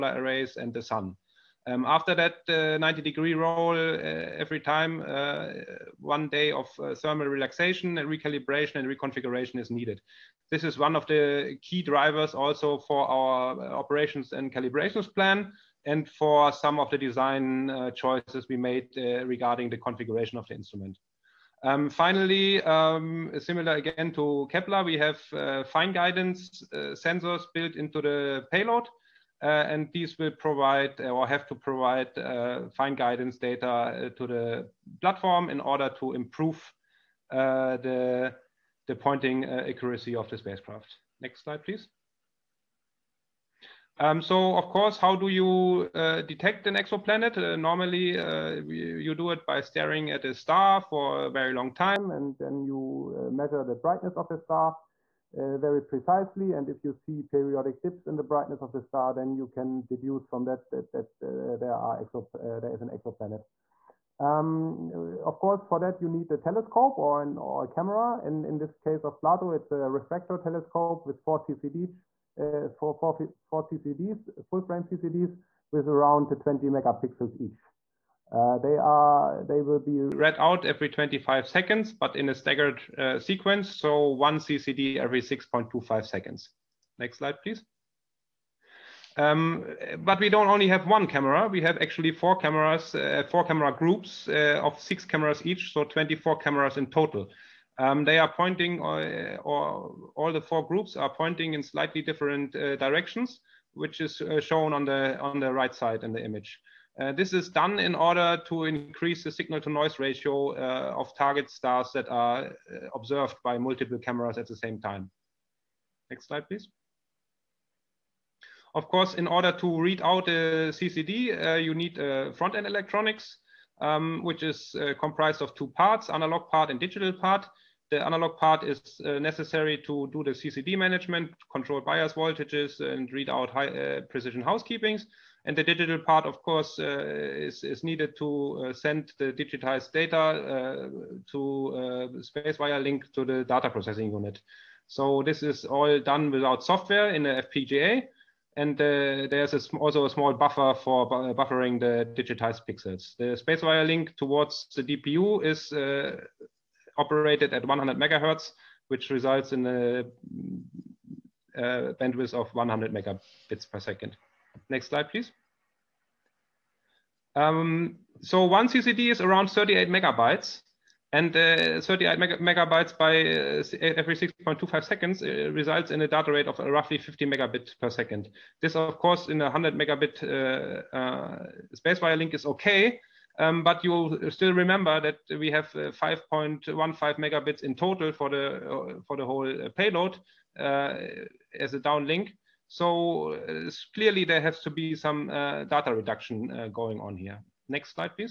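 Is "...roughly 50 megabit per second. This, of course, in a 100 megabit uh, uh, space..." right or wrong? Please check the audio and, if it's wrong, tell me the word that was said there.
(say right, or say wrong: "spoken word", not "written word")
right.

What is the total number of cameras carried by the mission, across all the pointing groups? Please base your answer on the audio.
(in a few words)
24.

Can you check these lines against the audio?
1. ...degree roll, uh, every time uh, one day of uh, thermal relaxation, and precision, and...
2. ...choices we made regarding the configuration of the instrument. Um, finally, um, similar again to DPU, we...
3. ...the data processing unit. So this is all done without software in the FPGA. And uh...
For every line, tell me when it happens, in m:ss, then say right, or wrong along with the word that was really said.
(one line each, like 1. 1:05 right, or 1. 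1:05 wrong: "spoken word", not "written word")
1. 0:03 wrong: "recalibration", not "precision"
2. 0:17 wrong: "Kepler", not "DPU"
3. 2:23 right.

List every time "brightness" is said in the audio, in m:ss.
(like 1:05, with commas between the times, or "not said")
0:53, 0:58.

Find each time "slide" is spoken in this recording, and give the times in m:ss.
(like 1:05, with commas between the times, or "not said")
0:41, 1:27, 1:56, 2:44.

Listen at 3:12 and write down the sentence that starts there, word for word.
So clearly there has to be some data reduction going on here.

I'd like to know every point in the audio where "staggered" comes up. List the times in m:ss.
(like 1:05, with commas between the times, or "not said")
1:22.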